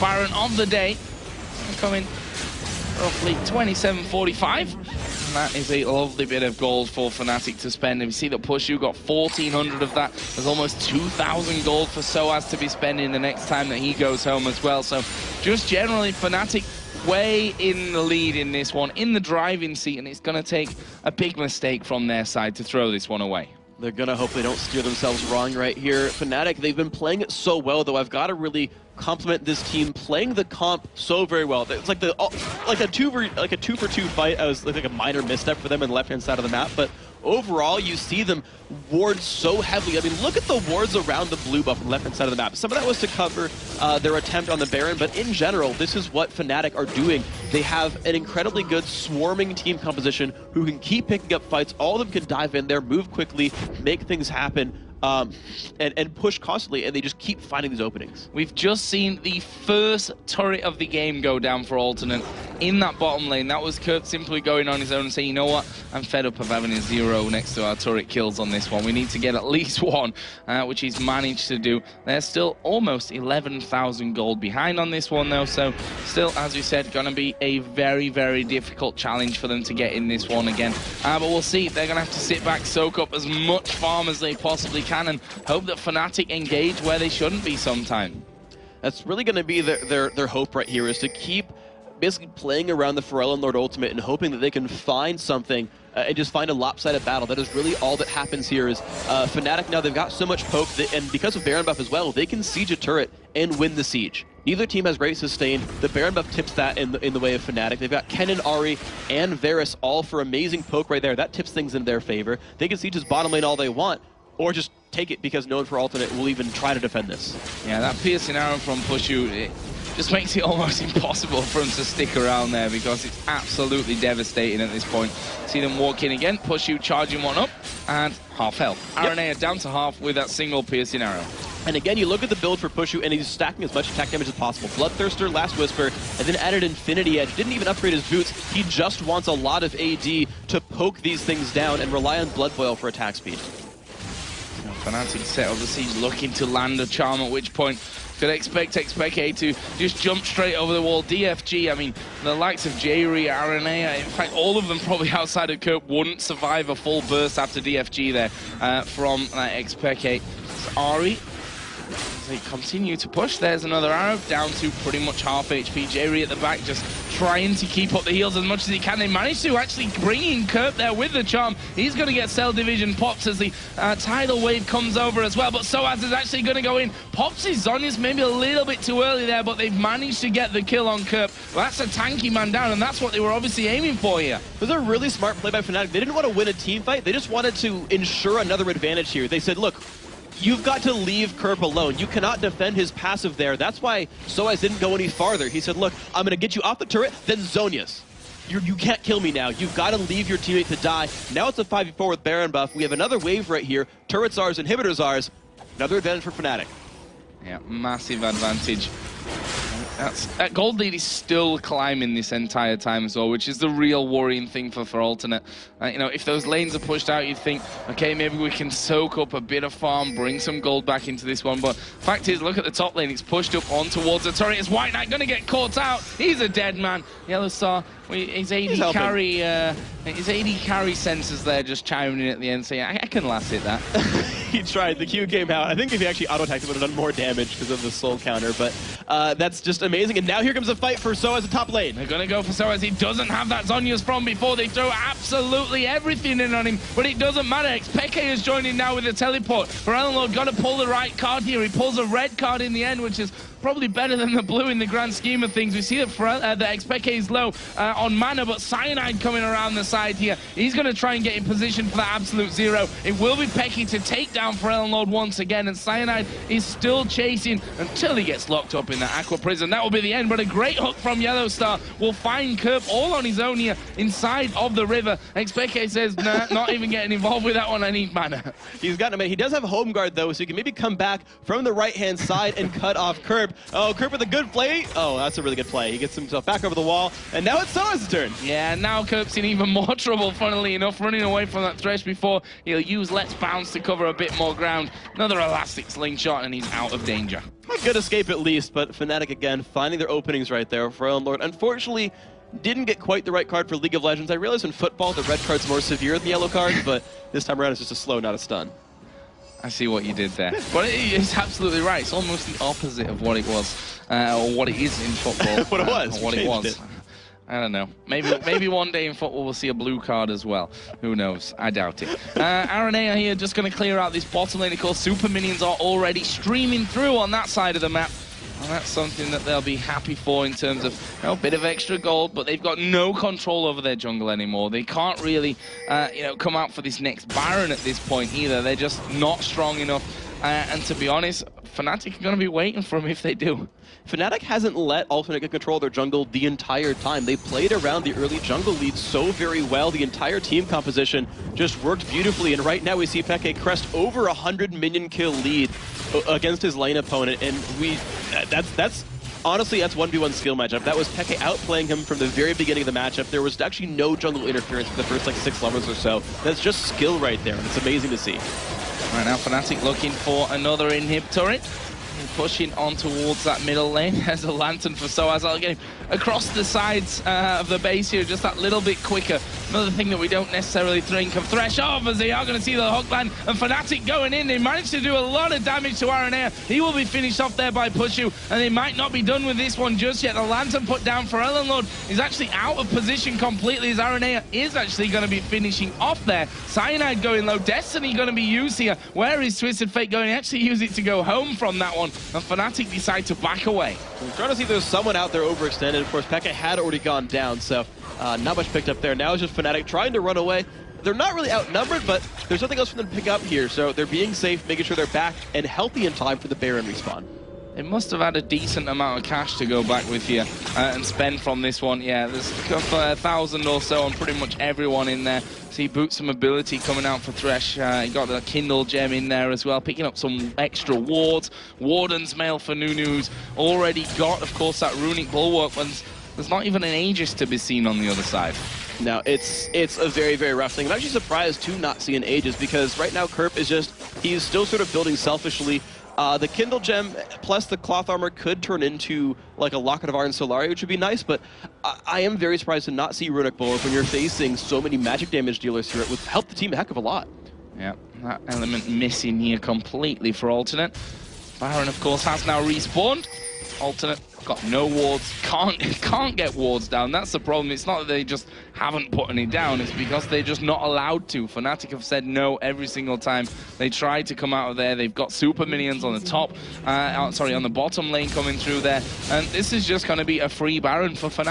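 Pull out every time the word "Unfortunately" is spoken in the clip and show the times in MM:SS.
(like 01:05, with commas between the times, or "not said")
05:01.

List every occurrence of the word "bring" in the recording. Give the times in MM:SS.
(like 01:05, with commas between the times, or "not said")
02:50, 03:40.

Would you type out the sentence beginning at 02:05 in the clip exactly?
See them walk in again, Puszu charging one up, and half health.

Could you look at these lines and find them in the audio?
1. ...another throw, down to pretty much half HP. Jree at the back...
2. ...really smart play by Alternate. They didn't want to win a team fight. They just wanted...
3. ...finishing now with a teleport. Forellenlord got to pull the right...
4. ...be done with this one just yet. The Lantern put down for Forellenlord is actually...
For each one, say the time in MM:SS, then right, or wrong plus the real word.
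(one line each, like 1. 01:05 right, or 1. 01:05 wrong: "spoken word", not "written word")
1. 02:43 wrong: "arrow", not "throw"
2. 03:04 wrong: "Fnatic", not "Alternate"
3. 04:08 wrong: "joining", not "finishing"
4. 06:29 right.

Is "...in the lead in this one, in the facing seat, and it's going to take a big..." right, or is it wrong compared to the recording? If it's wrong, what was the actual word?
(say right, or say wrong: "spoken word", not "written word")
wrong: "driving", not "facing".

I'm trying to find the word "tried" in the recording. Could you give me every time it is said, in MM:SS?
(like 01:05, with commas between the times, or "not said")
03:54.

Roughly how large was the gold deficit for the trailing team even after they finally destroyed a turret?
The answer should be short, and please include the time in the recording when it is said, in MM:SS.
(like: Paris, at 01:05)
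almost 11,000, at 01:12.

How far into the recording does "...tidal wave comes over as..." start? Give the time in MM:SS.
02:53.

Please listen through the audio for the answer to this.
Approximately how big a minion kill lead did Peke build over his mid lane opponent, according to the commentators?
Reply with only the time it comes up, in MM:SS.
05:53.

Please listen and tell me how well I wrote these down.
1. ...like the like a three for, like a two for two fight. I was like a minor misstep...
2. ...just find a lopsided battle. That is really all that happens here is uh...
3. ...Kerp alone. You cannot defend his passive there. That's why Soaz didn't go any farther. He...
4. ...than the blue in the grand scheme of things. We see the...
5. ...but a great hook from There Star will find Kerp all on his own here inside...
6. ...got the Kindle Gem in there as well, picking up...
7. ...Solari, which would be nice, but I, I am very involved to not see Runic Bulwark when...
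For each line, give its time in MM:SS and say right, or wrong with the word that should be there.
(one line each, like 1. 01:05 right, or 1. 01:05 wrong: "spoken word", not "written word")
1. 00:31 wrong: "two", not "three"
2. 01:36 right
3. 03:11 right
4. 04:14 right
5. 04:30 wrong: "Yellow", not "There"
6. 07:08 right
7. 07:30 wrong: "surprised", not "involved".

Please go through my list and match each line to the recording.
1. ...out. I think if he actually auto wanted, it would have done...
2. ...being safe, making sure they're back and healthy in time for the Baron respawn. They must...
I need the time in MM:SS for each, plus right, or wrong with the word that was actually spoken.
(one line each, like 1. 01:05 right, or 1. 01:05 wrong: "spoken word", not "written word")
1. 03:55 wrong: "attacked", not "wanted"
2. 06:54 right.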